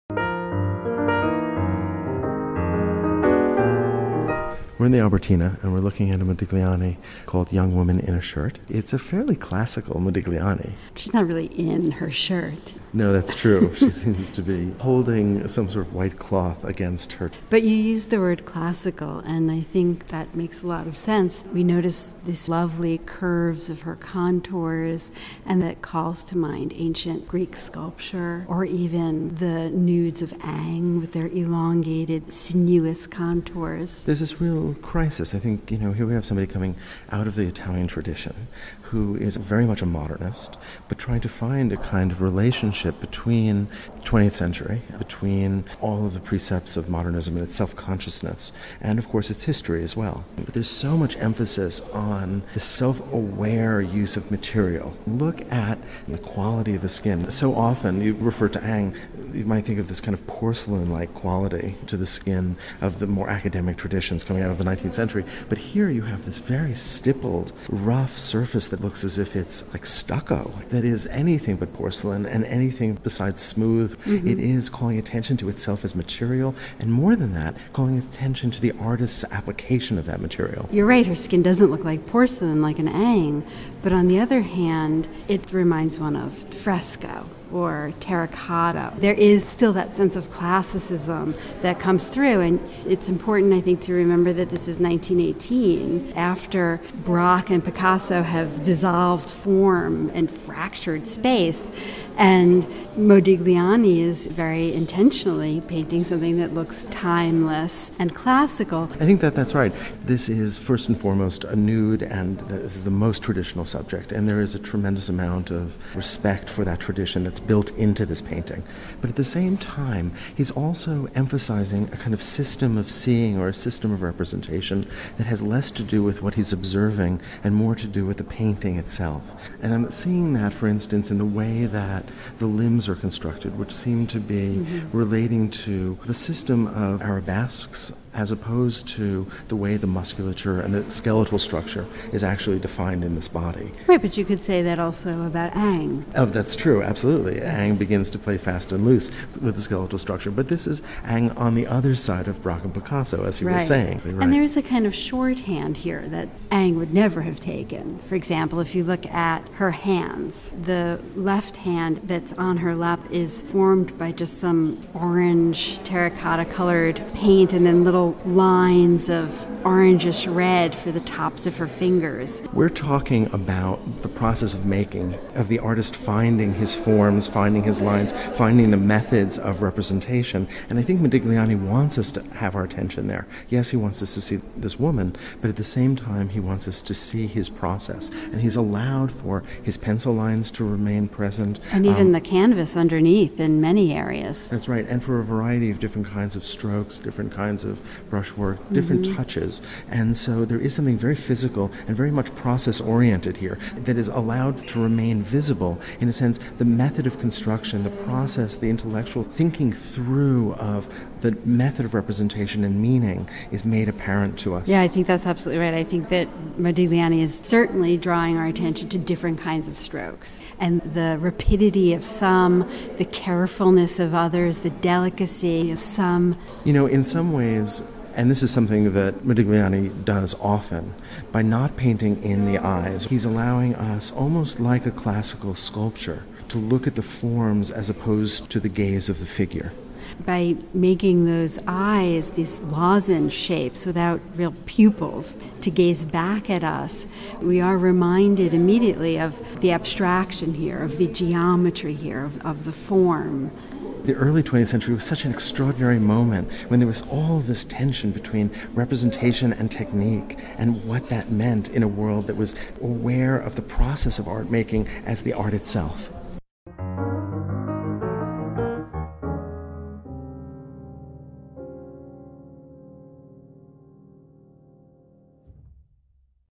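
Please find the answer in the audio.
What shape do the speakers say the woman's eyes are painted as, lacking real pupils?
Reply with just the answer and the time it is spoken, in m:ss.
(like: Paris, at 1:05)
Lozenge shapes, at 4:02.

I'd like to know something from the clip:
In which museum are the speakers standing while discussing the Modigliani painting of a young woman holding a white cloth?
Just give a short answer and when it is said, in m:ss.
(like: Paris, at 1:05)
Albertina, at 0:04.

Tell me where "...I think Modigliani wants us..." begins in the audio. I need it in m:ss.
3:00.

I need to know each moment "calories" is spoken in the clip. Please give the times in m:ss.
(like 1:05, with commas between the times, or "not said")
not said.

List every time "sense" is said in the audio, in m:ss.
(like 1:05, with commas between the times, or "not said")
0:20, 1:29, 3:26.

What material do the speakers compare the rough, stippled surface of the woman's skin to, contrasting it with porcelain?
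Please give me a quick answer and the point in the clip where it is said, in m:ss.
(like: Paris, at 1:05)
Stucco, at 1:09.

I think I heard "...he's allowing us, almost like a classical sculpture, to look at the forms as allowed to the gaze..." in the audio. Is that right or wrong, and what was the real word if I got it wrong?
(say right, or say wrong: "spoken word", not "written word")
wrong: "opposed", not "allowed".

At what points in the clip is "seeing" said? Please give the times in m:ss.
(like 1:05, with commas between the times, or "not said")
2:02, 2:09.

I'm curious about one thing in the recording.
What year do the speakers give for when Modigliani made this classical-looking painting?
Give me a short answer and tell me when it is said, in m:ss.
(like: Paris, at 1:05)
1918, at 1:34.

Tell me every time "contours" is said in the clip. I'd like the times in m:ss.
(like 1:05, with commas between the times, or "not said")
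0:23, 0:33.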